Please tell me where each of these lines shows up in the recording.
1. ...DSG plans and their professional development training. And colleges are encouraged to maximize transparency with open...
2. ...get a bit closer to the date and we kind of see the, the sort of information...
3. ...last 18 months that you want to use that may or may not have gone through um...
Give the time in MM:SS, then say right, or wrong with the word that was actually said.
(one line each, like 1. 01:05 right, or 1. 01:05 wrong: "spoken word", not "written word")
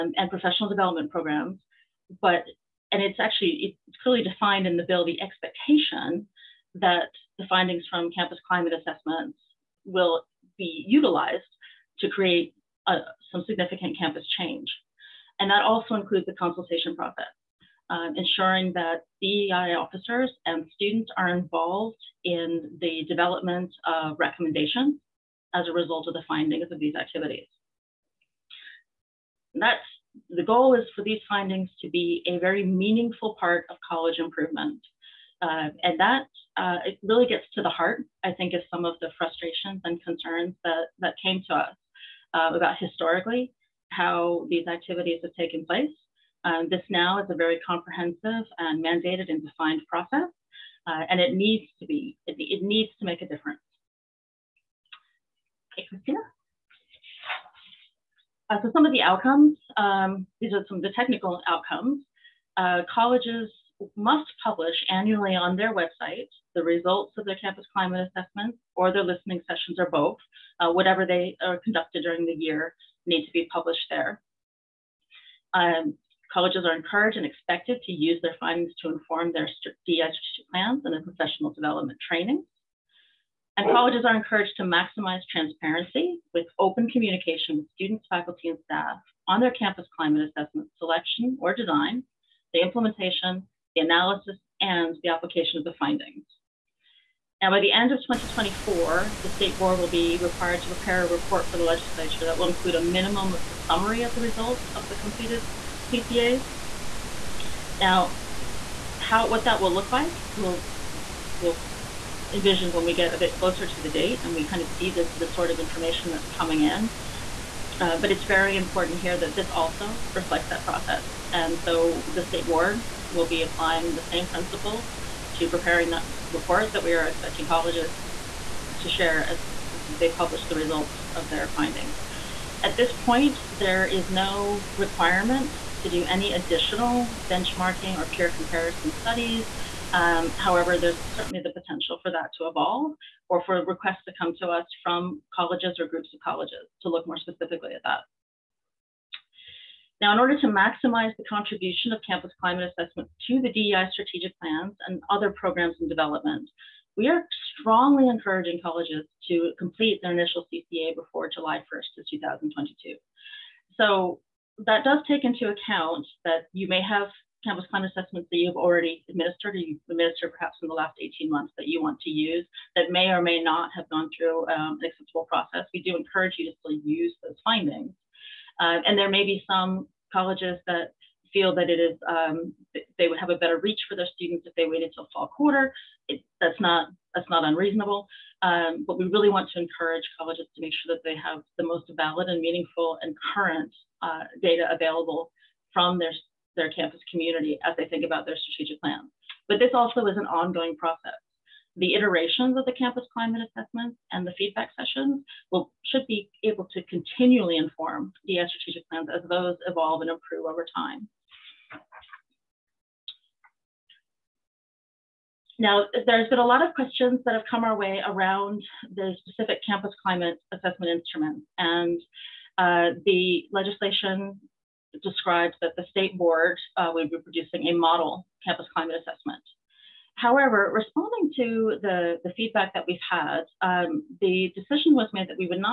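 1. 01:19 right
2. 01:52 right
3. 02:50 right.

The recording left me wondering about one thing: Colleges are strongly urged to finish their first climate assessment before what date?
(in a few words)
July 1st, 2022.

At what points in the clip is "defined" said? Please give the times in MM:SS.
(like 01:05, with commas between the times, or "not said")
00:04, 00:49.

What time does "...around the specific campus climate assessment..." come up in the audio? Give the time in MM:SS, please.
03:38.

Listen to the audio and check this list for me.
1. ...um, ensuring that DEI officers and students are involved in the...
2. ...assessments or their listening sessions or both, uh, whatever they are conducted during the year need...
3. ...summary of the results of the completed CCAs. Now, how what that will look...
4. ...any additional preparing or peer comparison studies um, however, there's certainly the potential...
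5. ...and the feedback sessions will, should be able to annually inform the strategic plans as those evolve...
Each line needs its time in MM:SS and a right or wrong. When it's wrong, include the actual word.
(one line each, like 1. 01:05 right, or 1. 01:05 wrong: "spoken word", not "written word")
1. 00:17 right
2. 01:08 right
3. 01:43 right
4. 02:16 wrong: "benchmarking", not "preparing"
5. 03:24 wrong: "continually", not "annually".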